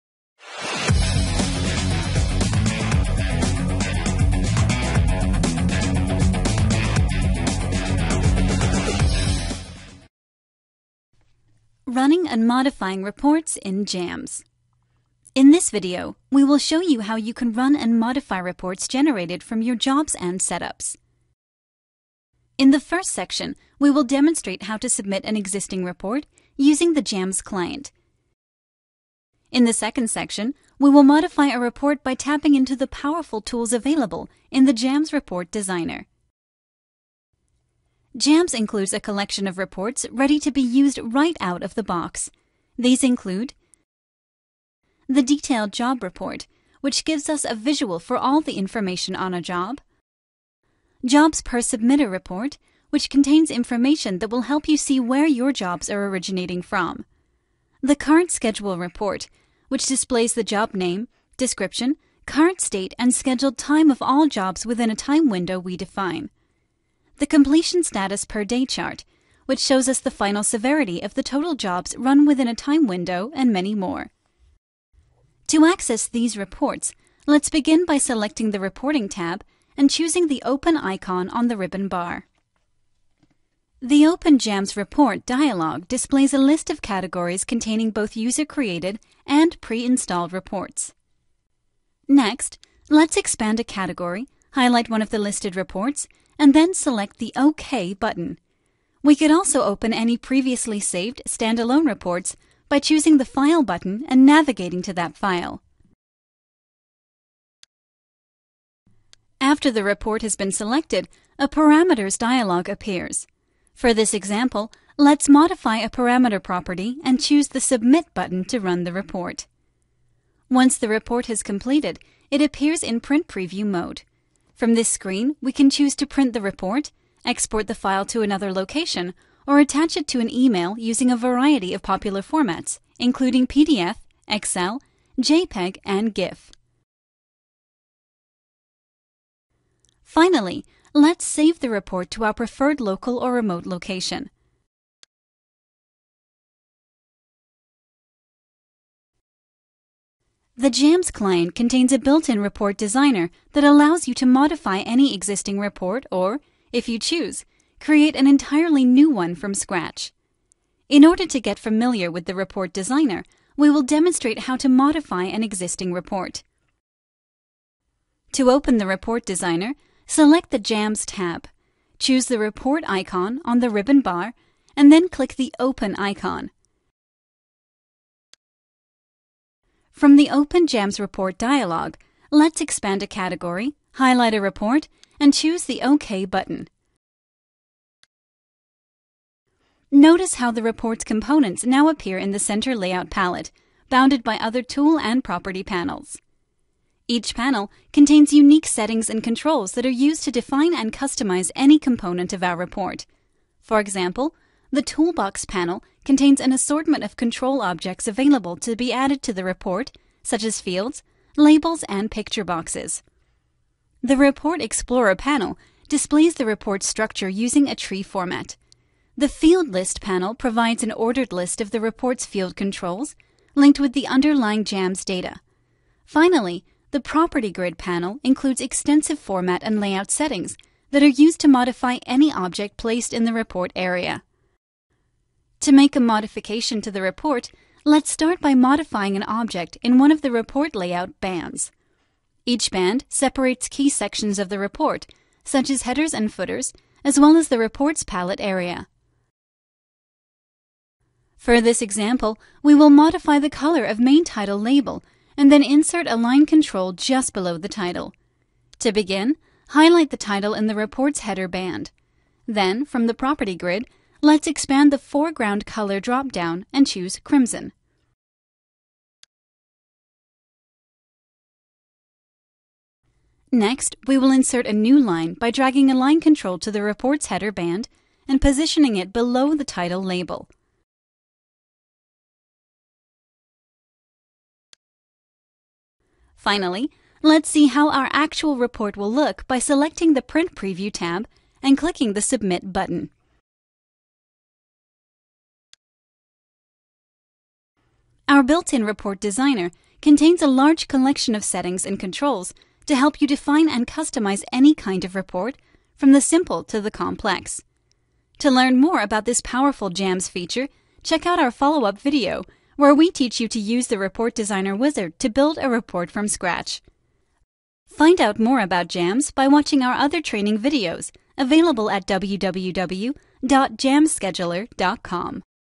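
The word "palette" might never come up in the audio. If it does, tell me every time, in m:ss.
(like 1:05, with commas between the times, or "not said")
3:13, 4:08.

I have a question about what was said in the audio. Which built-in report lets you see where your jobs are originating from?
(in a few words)
Jobs per submitter report.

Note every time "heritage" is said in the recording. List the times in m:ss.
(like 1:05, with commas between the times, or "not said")
not said.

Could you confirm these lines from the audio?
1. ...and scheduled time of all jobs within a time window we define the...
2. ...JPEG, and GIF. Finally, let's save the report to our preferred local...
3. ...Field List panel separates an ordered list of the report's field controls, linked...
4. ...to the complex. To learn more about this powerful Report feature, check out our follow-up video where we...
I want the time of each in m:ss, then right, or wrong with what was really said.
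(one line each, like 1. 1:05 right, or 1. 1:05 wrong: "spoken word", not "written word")
1. 1:02 right
2. 2:15 right
3. 3:39 wrong: "provides", not "separates"
4. 5:06 wrong: "JAMS", not "Report".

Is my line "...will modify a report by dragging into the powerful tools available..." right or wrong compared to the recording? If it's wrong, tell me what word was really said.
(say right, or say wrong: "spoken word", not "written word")
wrong: "tapping", not "dragging".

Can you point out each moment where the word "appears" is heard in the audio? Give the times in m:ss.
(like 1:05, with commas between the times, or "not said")
1:52, 2:02, 3:11.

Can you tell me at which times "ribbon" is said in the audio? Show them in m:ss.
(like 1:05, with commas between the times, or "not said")
1:21, 2:53.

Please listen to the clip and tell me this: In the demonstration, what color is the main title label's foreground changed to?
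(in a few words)
Crimson.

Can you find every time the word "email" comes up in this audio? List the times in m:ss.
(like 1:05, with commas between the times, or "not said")
2:10.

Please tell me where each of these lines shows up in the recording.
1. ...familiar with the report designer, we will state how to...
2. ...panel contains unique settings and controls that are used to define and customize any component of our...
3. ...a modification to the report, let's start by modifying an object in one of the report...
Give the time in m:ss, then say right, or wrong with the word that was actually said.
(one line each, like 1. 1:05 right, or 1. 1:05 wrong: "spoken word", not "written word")
1. 2:41 wrong: "demonstrate", not "state"
2. 3:17 right
3. 3:55 right.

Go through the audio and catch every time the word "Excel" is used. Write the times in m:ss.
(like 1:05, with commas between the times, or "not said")
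2:14.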